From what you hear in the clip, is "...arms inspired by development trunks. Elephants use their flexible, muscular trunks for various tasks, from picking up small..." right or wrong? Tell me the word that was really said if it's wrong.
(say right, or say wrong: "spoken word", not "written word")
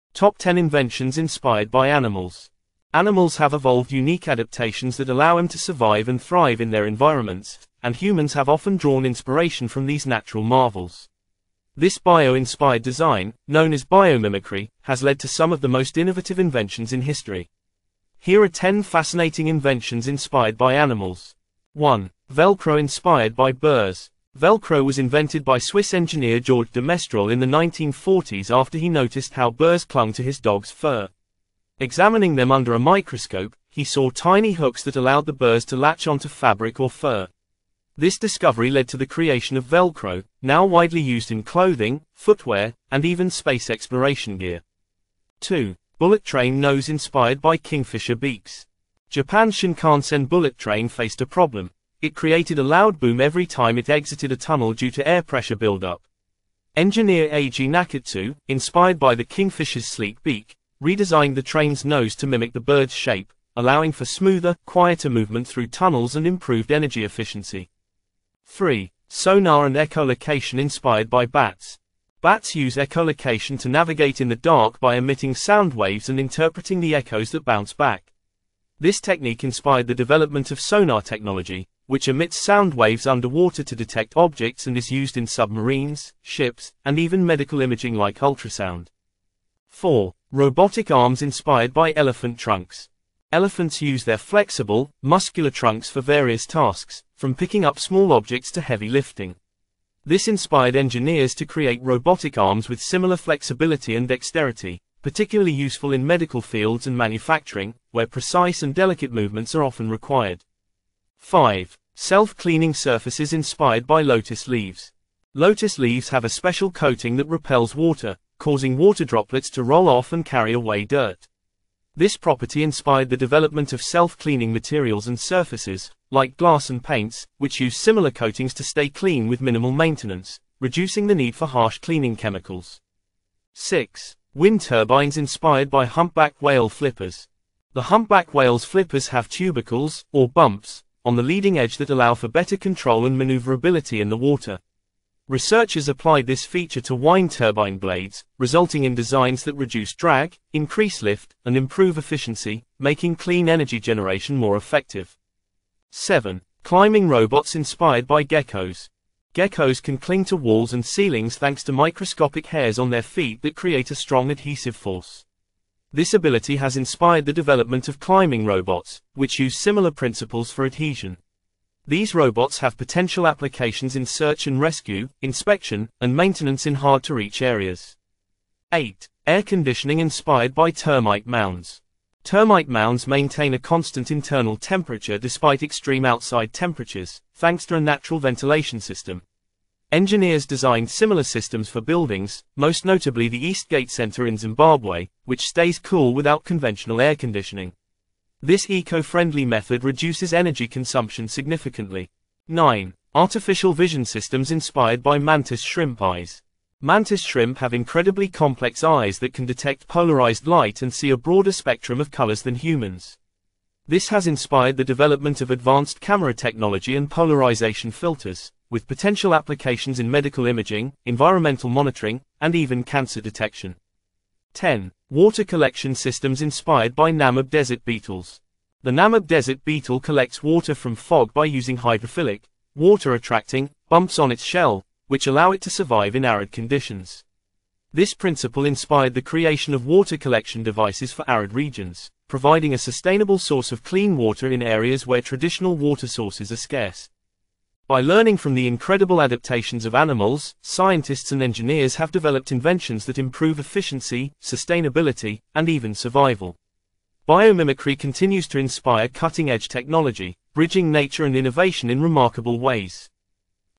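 wrong: "elephant", not "development".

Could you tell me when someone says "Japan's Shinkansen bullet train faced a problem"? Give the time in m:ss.
0:49.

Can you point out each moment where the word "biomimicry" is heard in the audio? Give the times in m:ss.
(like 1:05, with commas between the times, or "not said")
0:13, 4:17.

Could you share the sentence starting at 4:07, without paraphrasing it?
By learning from the incredible adaptations of animals, scientists and engineers have developed inventions that improve efficiency, sustainability, and even survival.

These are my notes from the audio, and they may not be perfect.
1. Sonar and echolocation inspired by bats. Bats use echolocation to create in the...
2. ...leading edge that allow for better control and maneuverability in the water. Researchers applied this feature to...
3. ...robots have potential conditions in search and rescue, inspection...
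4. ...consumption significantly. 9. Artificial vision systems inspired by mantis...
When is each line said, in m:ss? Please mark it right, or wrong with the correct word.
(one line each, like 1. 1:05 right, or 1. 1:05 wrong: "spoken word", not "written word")
1. 1:09 wrong: "navigate", not "create"
2. 2:21 right
3. 2:52 wrong: "applications", not "conditions"
4. 3:20 right.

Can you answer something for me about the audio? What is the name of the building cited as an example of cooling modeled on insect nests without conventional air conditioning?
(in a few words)
Eastgate Center.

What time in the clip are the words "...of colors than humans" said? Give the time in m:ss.
3:31.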